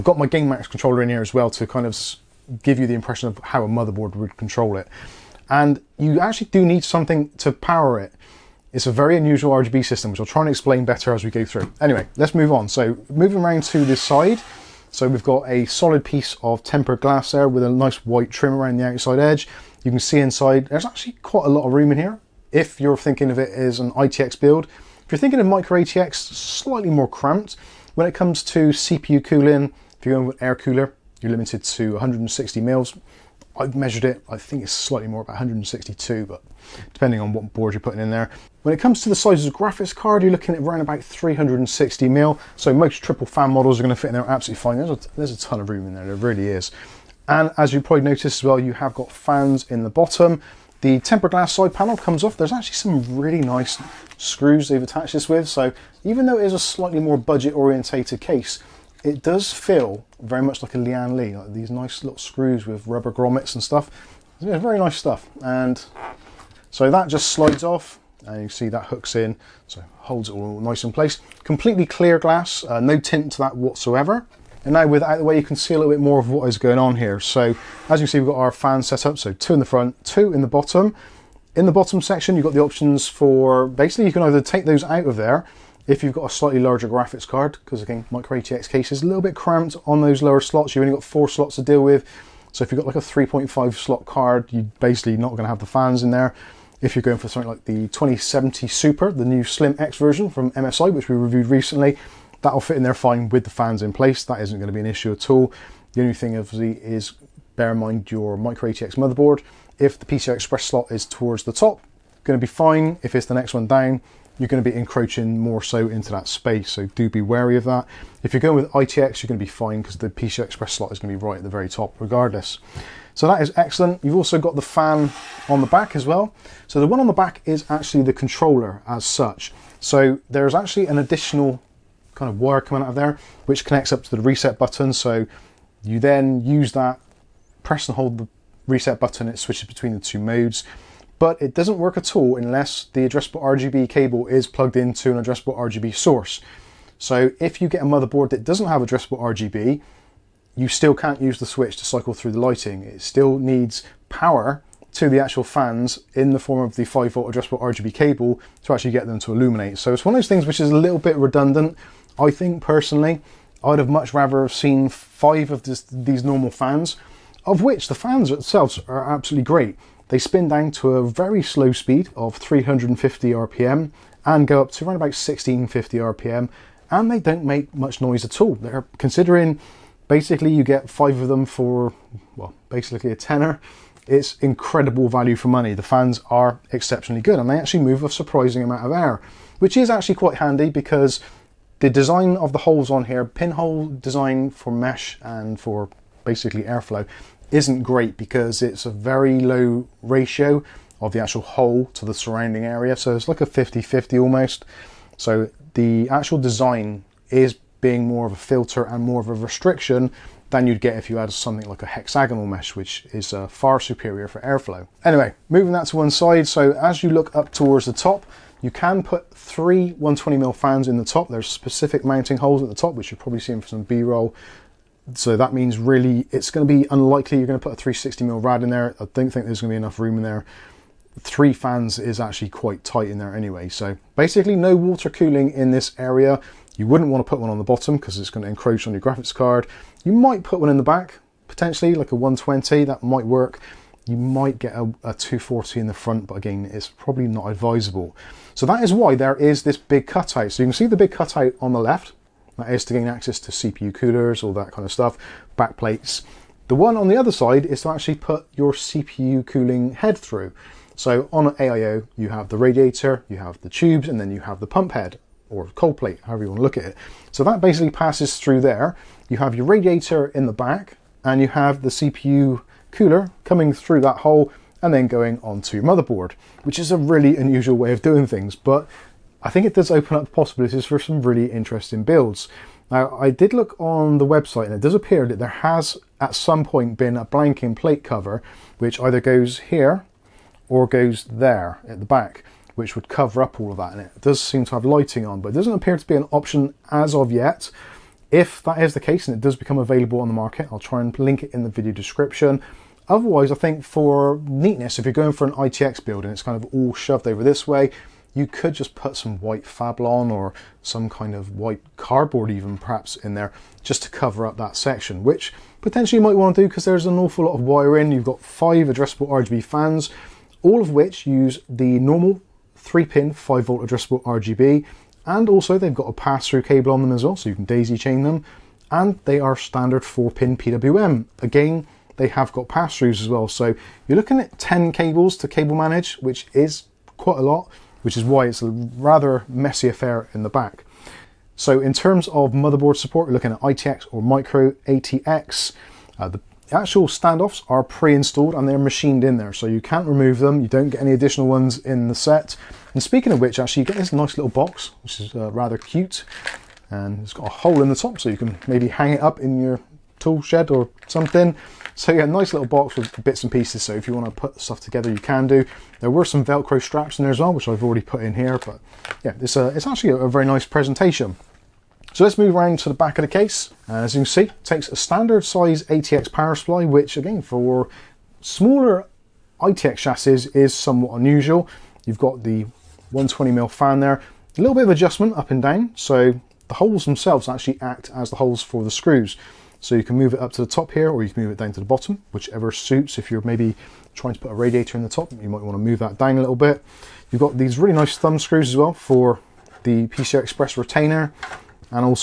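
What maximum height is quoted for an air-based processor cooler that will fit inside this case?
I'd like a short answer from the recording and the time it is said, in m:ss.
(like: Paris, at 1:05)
160mm, at 0:31.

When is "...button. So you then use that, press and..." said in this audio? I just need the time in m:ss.
2:14.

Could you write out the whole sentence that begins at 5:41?
So in terms of motherboard support, we're looking at ITX or Micro ATX.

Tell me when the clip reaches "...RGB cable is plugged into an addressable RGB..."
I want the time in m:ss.
2:23.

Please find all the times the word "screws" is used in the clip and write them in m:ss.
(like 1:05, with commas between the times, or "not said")
0:54, 1:02, 6:28, 6:38.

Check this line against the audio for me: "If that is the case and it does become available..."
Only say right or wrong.
right.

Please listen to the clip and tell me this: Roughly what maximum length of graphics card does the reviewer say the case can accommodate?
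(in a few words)
360mm.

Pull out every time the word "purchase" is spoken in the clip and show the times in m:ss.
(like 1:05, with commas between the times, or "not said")
not said.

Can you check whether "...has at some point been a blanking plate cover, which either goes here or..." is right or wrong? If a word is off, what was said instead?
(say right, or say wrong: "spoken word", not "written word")
right.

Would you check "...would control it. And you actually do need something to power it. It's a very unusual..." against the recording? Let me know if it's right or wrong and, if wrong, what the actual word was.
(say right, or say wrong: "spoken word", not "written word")
right.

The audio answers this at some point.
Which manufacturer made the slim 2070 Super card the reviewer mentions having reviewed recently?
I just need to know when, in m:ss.
1:40.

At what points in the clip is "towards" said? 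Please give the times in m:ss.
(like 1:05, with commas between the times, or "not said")
1:51, 3:37.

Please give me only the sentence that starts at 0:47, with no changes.
And as you probably noticed as well, you have got fans in the bottom.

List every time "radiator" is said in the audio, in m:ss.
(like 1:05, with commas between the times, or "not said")
4:22, 4:29, 6:34.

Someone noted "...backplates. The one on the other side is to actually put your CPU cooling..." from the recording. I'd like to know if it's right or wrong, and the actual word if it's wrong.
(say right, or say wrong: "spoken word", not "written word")
right.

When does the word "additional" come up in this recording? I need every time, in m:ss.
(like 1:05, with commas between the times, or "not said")
2:10, 5:51.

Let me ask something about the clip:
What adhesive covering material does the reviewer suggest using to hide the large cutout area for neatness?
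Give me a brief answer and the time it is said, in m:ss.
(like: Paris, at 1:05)
White Fablon, at 5:09.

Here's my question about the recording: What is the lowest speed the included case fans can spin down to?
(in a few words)
350 RPM.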